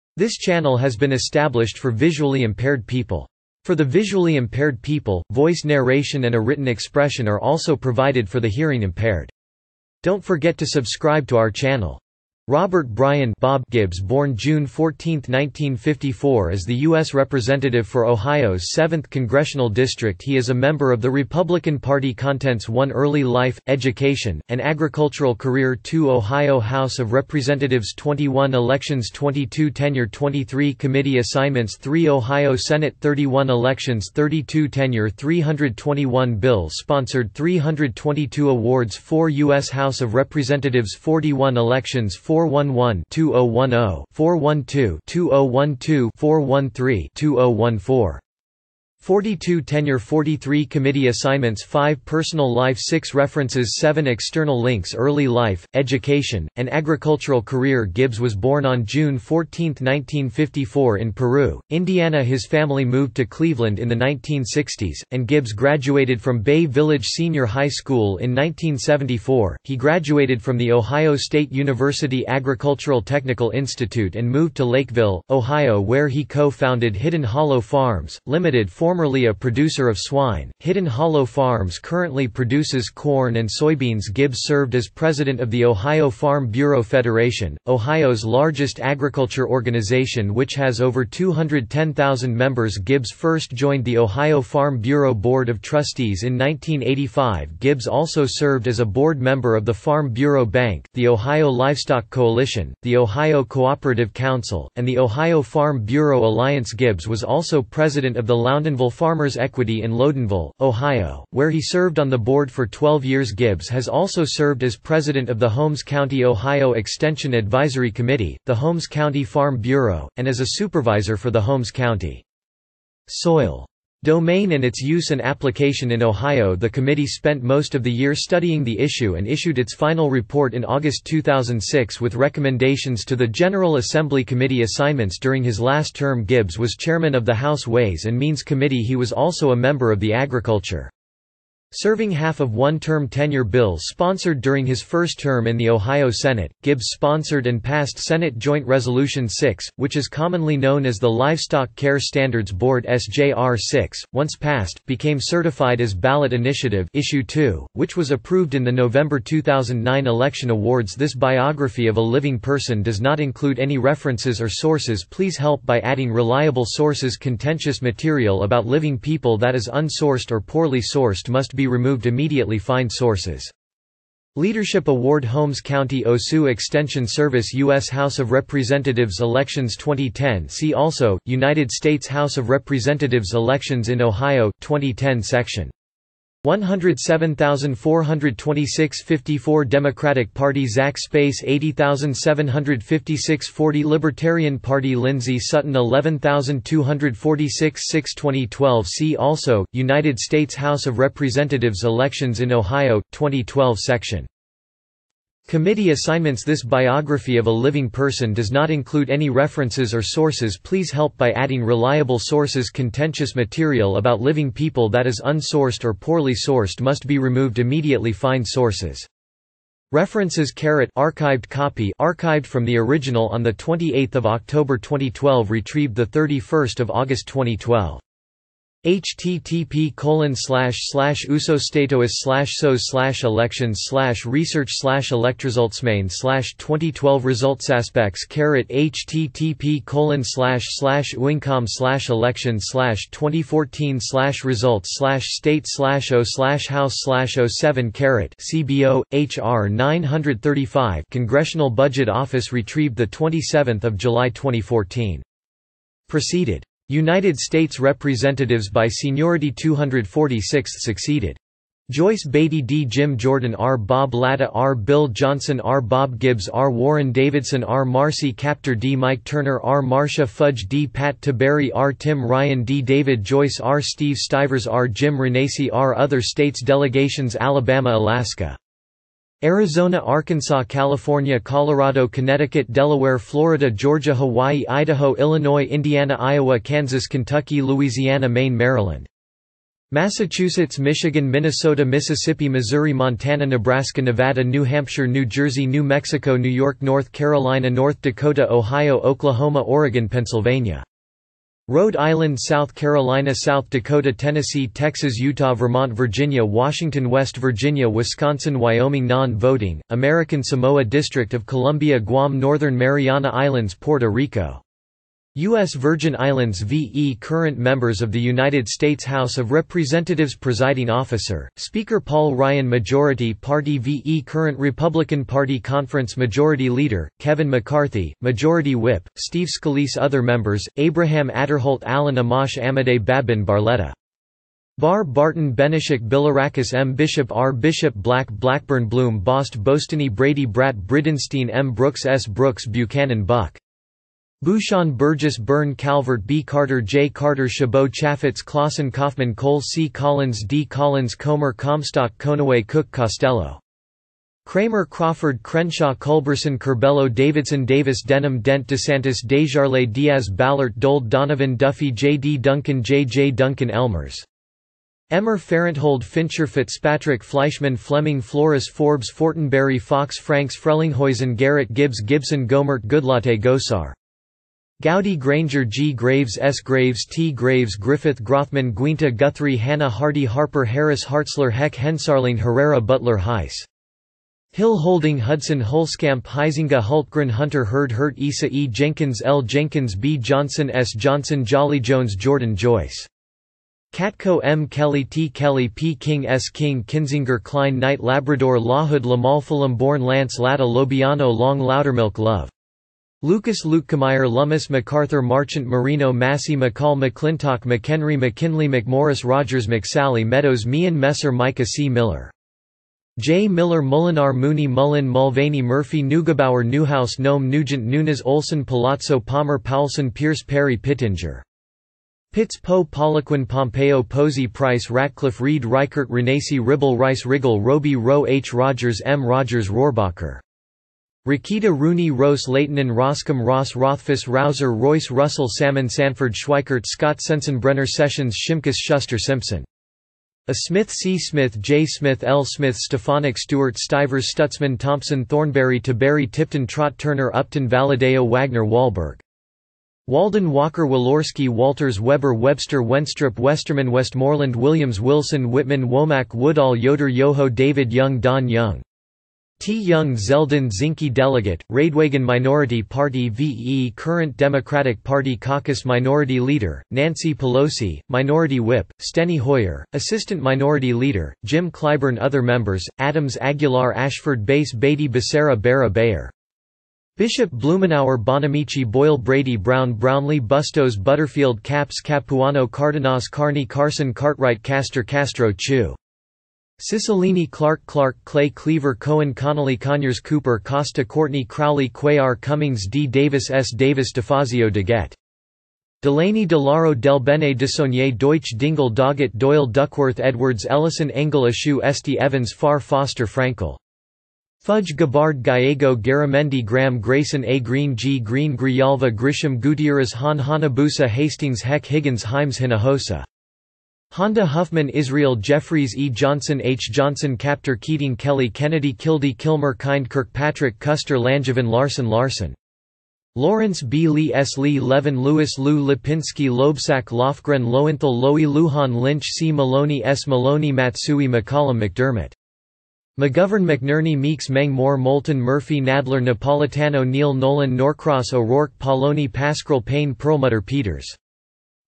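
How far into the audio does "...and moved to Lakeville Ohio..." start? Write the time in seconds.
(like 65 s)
74 s.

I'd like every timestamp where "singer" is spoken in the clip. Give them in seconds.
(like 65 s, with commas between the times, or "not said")
not said.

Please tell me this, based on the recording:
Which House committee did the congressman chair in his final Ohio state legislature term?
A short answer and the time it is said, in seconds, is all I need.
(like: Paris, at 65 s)
Ways and Means, at 137 s.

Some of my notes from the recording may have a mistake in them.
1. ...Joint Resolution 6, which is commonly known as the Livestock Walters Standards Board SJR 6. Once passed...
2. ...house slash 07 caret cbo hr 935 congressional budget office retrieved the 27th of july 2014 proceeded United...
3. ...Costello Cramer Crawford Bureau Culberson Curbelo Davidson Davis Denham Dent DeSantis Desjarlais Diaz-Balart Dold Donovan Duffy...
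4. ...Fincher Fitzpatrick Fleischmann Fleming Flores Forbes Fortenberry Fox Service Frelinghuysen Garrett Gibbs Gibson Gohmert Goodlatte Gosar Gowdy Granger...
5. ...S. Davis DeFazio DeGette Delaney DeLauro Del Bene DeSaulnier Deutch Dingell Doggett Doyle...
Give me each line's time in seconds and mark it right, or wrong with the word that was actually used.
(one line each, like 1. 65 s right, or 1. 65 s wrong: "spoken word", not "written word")
1. 148 s wrong: "Care", not "Walters"
2. 246 s right
3. 352 s wrong: "Crenshaw", not "Bureau"
4. 366 s wrong: "Franks", not "Service"
5. 493 s right.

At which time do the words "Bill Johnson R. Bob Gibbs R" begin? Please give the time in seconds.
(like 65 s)
264 s.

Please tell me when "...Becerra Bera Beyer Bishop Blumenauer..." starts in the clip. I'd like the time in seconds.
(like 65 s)
475 s.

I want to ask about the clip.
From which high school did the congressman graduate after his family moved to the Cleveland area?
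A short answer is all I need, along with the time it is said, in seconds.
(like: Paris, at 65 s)
Bay Village Senior High School, at 66 s.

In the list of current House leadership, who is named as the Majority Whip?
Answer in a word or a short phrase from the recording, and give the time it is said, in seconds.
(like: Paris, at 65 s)
Steve Scalise, at 329 s.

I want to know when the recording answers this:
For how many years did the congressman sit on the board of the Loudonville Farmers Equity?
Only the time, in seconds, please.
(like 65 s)
112 s.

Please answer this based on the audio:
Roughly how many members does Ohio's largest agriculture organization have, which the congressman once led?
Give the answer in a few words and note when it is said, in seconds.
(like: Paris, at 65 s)
210,000, at 91 s.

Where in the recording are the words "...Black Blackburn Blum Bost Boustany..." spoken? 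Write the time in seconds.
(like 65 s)
337 s.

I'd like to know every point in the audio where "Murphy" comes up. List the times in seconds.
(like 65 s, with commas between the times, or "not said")
415 s, 535 s.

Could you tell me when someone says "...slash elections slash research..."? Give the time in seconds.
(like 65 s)
232 s.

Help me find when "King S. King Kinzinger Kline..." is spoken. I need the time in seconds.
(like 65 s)
395 s.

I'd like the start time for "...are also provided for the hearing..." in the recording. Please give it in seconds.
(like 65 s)
7 s.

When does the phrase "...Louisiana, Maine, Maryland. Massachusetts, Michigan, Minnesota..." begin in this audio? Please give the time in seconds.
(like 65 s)
287 s.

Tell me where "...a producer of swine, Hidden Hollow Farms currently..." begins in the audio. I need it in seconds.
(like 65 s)
79 s.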